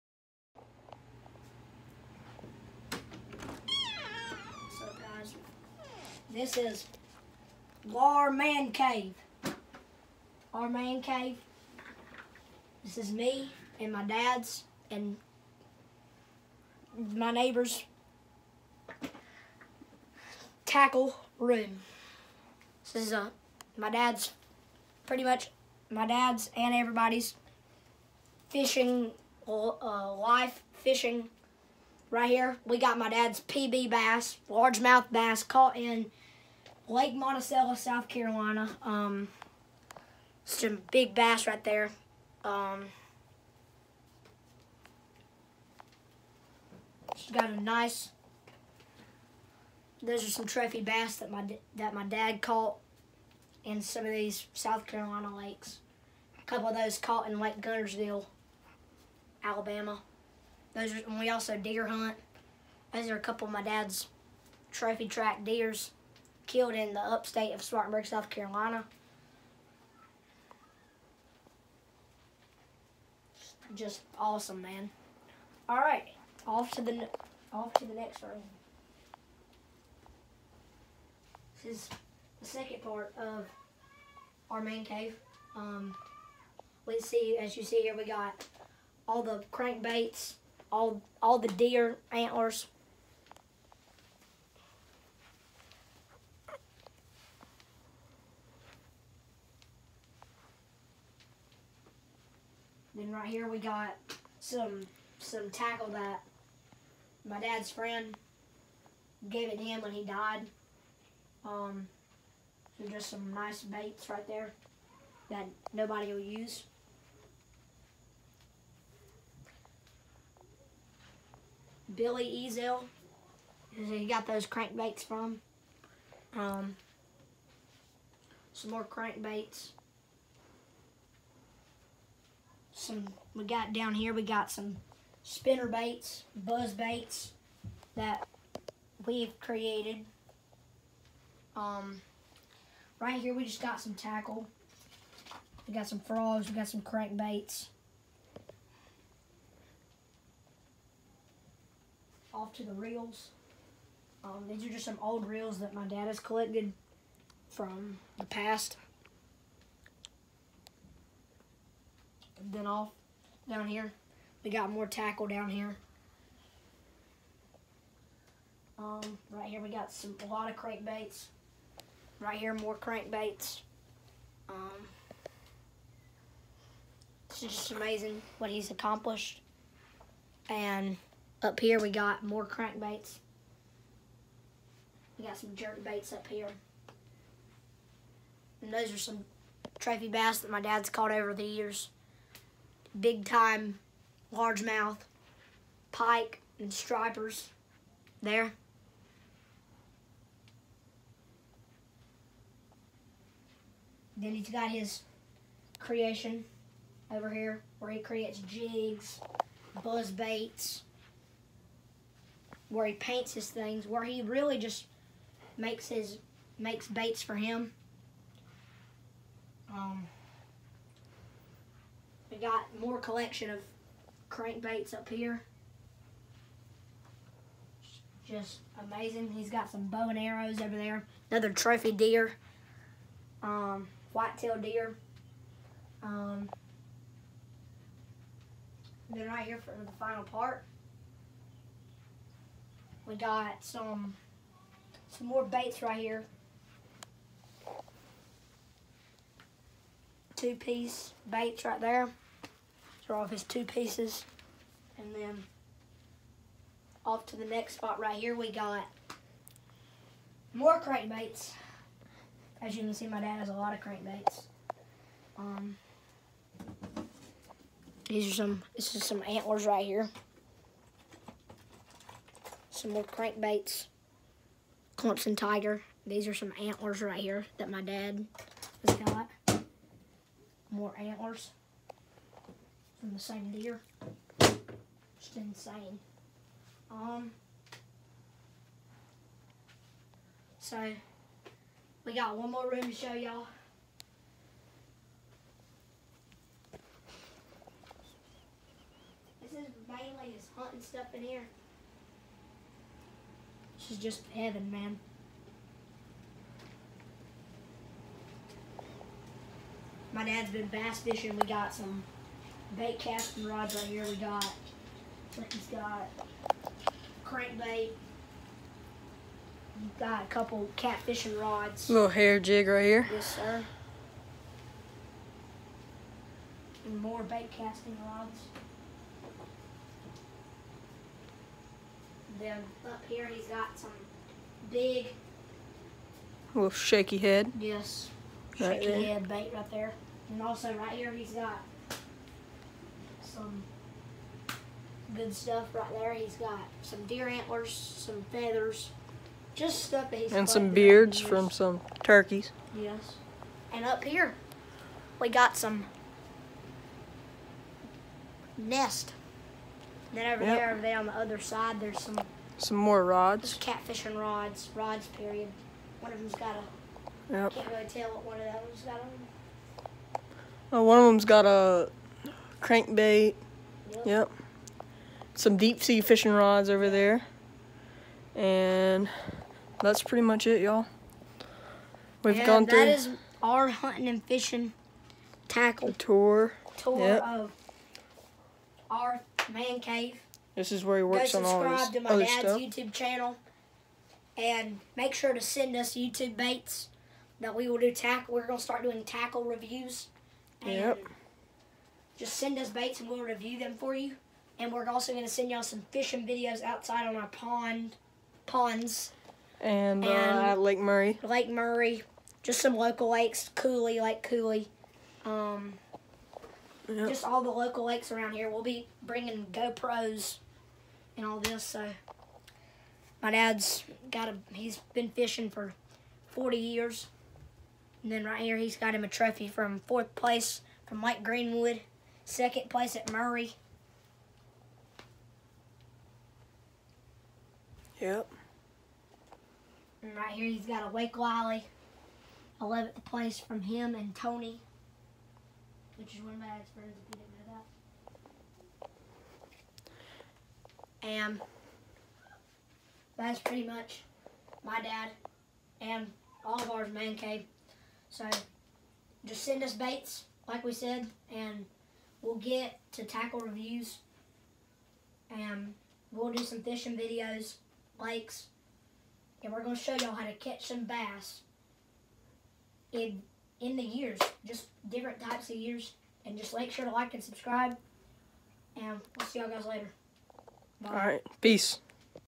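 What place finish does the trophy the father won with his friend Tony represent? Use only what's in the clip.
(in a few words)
11th place.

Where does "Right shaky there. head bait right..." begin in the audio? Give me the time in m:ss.
5:38.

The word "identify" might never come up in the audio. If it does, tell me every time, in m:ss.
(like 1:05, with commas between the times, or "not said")
not said.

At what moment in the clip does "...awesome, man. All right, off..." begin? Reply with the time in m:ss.
1:14.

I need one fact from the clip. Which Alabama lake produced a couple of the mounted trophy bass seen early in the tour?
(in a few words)
Lake Guntersville.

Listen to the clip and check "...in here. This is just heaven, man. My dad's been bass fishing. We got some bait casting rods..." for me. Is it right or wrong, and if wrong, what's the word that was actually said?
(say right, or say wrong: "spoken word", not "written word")
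right.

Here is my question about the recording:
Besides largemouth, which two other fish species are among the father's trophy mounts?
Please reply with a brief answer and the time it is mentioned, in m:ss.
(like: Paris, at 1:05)
Pike and stripers, at 3:15.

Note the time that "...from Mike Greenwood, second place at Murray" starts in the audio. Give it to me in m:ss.
7:10.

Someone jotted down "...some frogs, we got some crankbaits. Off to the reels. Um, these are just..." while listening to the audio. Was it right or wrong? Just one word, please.
right.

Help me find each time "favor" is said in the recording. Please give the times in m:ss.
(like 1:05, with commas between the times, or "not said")
not said.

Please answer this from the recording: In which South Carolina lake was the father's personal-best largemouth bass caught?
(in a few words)
Lake Monticello.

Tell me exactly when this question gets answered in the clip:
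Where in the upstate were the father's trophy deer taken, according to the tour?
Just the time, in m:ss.
1:07.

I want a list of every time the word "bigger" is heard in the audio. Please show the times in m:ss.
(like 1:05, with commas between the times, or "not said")
not said.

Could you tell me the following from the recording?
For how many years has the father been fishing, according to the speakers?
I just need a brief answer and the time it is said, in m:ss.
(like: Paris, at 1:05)
40, at 7:06.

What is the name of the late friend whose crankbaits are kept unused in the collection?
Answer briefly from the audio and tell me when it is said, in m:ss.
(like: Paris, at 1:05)
Billy Ezel, at 2:01.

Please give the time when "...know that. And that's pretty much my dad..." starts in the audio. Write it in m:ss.
7:28.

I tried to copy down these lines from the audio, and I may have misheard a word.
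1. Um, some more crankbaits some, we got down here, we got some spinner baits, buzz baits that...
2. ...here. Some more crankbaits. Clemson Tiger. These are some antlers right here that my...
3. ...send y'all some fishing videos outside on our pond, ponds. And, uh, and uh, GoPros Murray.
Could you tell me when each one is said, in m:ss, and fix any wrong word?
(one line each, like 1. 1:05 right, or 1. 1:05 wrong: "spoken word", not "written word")
1. 2:06 right
2. 4:29 right
3. 6:45 wrong: "Lake", not "GoPros".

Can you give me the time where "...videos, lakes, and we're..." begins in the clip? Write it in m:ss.
7:46.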